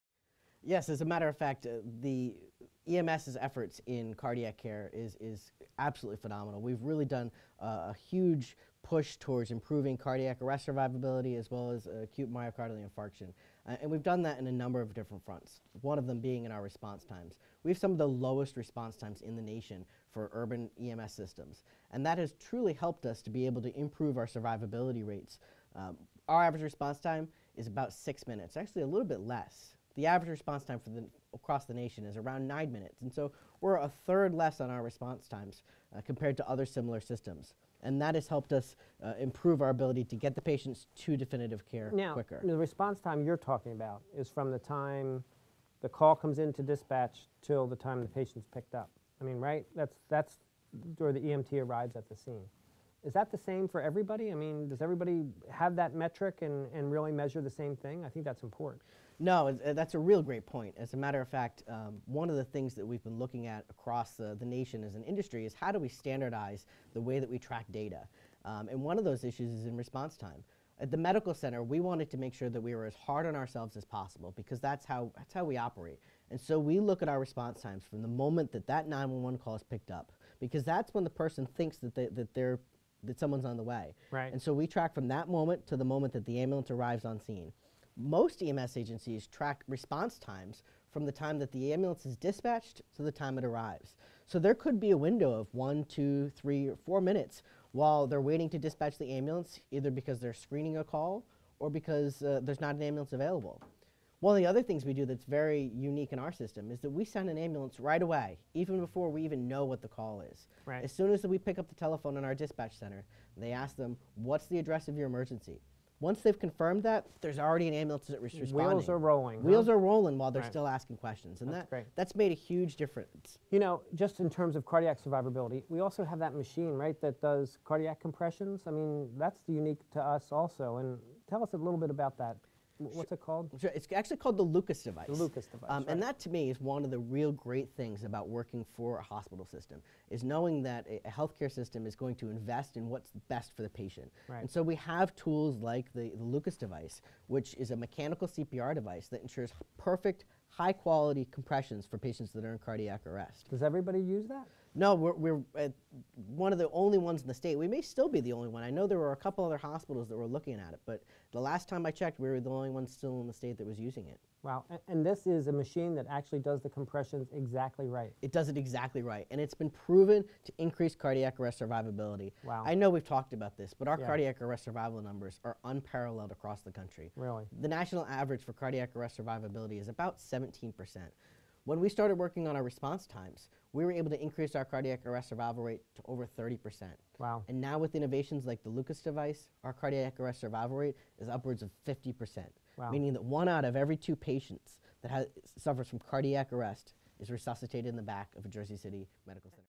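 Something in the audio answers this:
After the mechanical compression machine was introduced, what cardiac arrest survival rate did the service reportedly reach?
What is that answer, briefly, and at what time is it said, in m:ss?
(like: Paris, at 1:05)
50%, at 3:11.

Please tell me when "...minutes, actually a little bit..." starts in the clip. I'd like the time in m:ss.
0:28.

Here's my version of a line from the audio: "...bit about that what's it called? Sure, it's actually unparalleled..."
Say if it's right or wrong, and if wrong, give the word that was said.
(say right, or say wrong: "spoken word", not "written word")
wrong: "called", not "unparalleled".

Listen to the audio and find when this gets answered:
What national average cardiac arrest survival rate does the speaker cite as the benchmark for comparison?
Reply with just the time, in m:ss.
3:00.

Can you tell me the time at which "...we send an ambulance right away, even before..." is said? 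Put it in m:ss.
1:46.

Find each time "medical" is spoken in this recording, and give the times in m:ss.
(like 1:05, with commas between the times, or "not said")
1:10, 3:19.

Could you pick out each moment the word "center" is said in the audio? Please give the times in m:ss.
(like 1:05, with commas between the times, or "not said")
1:11, 1:52, 3:19.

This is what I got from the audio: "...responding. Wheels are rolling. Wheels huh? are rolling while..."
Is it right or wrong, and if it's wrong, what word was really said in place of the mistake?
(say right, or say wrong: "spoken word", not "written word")
right.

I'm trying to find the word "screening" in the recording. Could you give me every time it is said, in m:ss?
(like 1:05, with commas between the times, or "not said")
1:40.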